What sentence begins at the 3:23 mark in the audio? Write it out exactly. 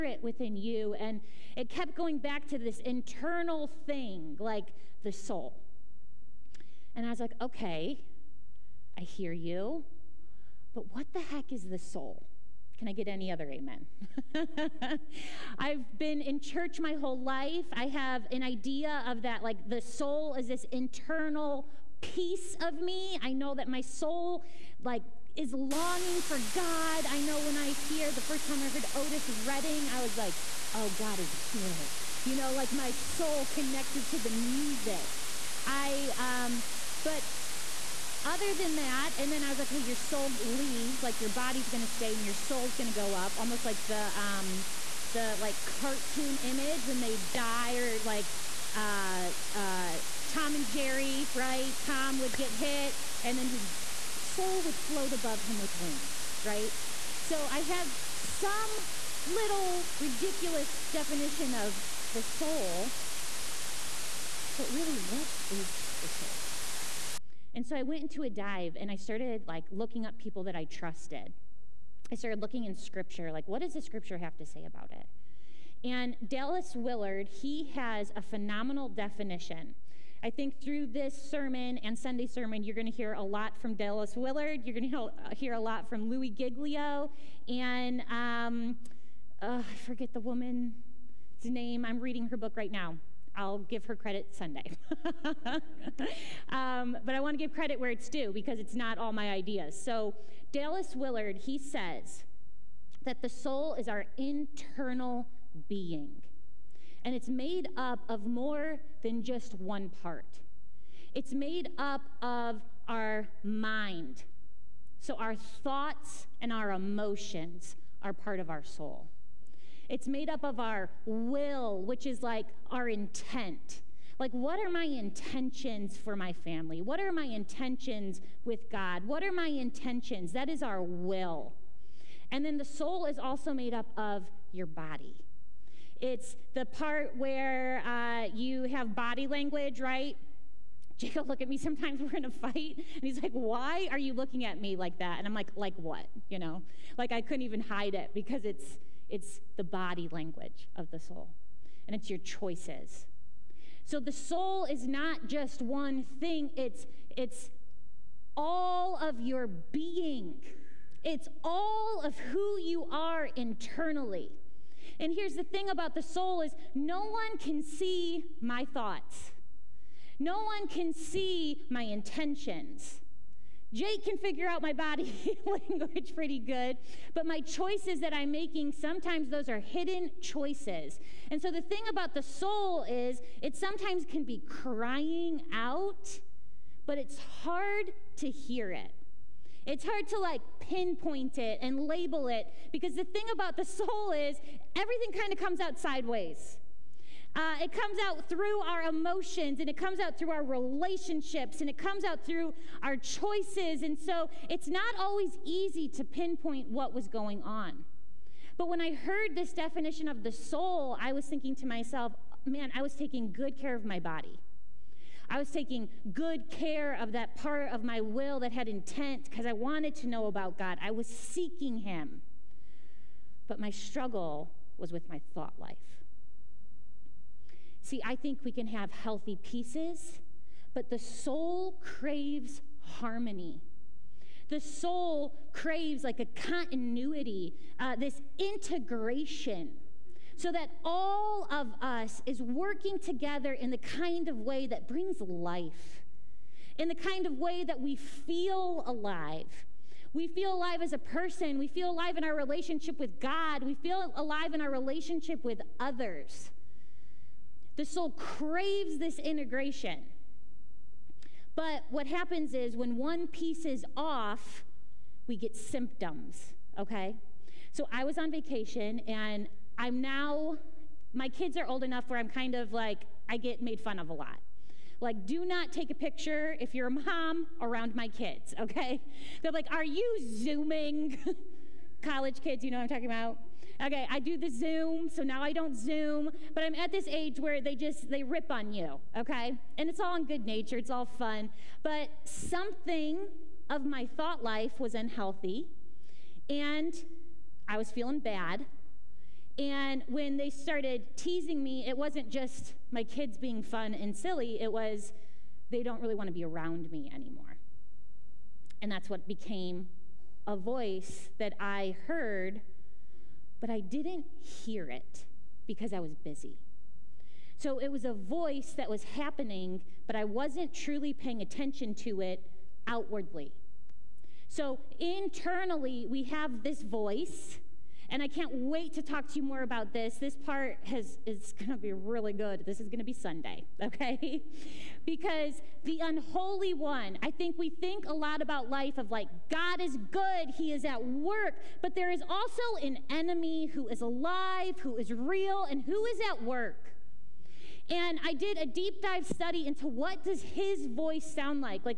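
And so it's not always easy to pinpoint what was going on.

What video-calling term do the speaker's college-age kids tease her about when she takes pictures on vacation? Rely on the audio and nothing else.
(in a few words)
Zooming.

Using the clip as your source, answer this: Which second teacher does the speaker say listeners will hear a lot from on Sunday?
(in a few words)
Louis Giglio.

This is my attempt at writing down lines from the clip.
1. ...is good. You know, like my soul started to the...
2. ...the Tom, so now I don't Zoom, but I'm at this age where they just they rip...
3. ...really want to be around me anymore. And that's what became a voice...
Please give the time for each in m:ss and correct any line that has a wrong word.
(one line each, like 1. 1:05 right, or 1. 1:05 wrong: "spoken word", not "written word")
1. 0:31 wrong: "connected", not "started"
2. 4:44 wrong: "Zoom", not "Tom"
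3. 5:06 right.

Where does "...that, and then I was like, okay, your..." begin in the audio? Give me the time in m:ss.
0:38.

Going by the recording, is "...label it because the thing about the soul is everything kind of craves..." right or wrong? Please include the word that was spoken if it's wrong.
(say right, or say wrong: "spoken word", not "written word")
wrong: "comes", not "craves".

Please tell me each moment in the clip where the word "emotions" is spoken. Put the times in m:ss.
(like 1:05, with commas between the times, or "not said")
1:56, 3:18.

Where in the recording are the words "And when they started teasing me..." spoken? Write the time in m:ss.
4:59.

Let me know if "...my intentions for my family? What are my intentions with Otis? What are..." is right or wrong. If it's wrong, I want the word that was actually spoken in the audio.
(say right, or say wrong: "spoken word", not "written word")
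wrong: "God", not "Otis".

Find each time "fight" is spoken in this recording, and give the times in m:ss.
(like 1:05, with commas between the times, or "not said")
2:22.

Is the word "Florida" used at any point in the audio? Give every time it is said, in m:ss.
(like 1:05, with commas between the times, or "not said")
not said.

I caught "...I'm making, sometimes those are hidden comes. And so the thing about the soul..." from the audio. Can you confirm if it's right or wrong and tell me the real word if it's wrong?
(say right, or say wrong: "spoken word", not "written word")
wrong: "choices", not "comes".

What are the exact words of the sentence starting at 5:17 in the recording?
So it was a voice that was happening, but I wasn't truly paying attention to it outwardly.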